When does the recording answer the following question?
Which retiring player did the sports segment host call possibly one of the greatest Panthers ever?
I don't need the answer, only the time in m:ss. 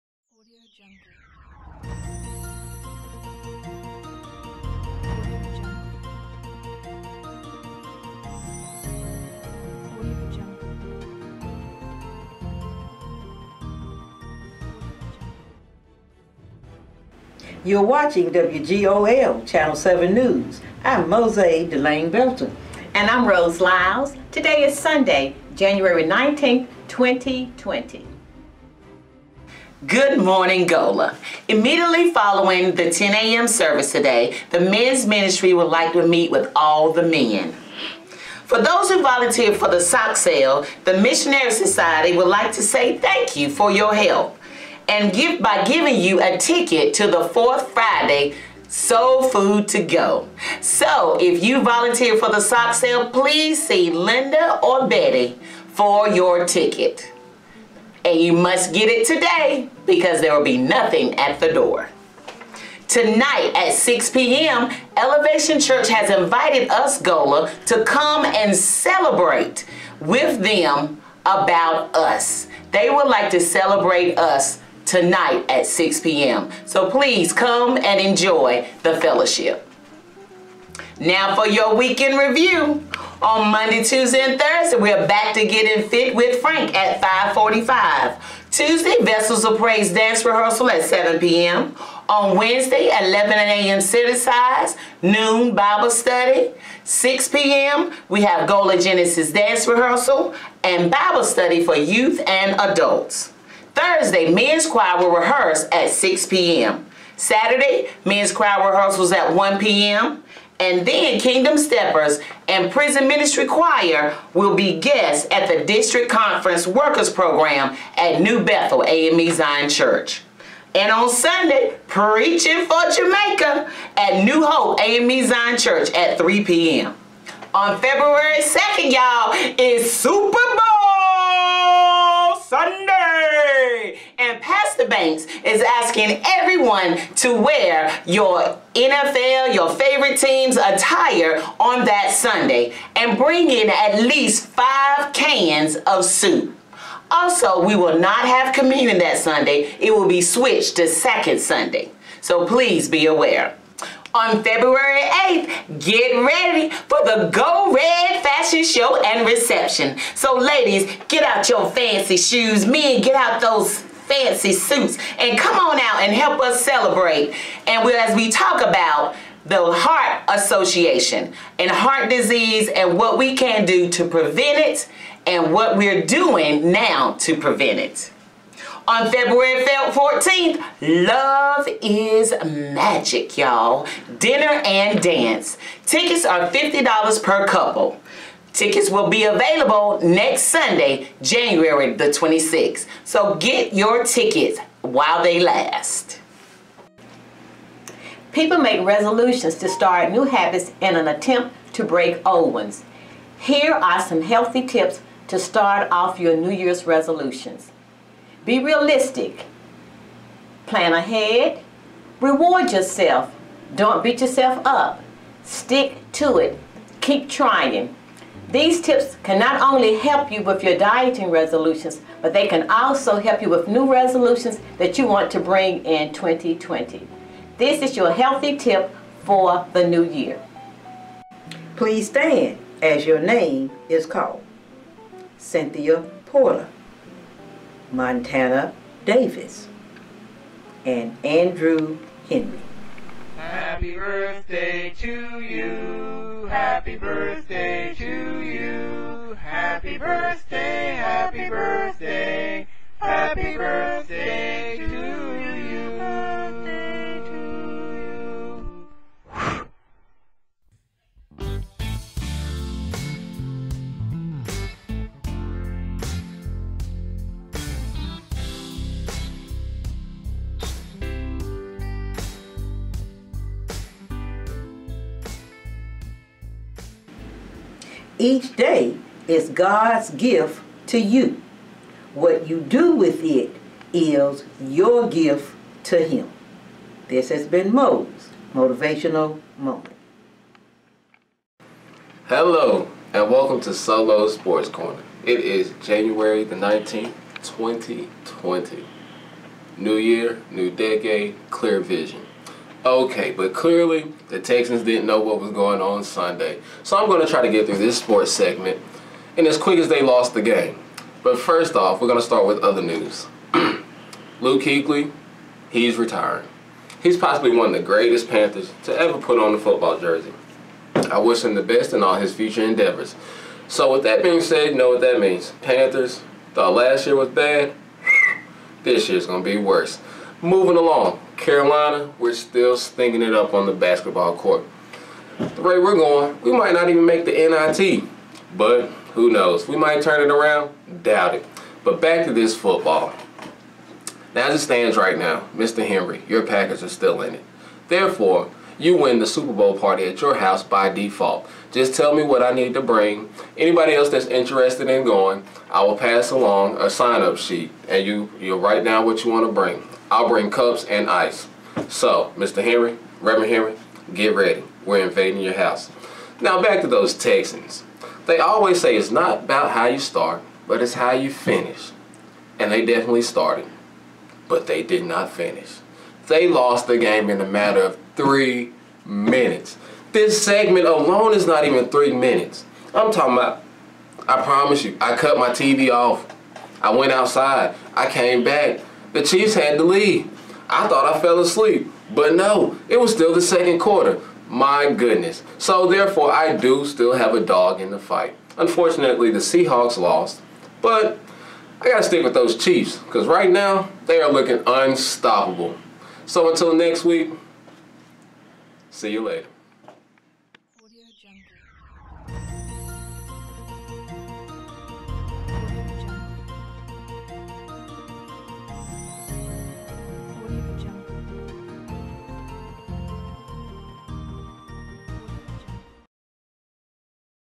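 5:14.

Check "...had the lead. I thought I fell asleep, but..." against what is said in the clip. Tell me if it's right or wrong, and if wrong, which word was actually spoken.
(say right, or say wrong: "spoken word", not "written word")
right.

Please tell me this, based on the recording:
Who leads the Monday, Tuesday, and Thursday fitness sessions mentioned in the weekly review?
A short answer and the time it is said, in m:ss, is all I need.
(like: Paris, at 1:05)
Frank, at 1:26.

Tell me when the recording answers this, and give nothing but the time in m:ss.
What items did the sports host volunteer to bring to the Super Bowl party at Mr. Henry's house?
6:00.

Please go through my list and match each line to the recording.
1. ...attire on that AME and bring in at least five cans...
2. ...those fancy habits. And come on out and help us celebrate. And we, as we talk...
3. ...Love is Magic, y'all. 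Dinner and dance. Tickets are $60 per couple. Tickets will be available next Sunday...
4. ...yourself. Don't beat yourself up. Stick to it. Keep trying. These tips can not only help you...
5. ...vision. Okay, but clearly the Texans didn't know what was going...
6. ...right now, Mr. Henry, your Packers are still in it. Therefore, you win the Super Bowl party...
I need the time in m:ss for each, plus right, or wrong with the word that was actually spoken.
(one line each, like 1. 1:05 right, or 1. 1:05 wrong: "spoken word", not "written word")
1. 2:20 wrong: "Sunday", not "AME"
2. 2:43 wrong: "suits", not "habits"
3. 3:01 wrong: "50", not "60"
4. 3:32 right
5. 5:01 right
6. 5:44 right.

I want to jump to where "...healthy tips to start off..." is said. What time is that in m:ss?
3:24.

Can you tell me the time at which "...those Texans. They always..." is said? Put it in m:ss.
6:06.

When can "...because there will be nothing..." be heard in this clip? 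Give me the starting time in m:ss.
0:59.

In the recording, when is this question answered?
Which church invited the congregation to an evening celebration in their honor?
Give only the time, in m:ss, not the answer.
1:04.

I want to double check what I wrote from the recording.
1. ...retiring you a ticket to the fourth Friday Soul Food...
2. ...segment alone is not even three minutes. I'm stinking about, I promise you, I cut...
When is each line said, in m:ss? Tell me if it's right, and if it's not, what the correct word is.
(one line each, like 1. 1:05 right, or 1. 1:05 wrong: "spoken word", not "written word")
1. 0:45 wrong: "giving", not "retiring"
2. 6:20 wrong: "talking", not "stinking".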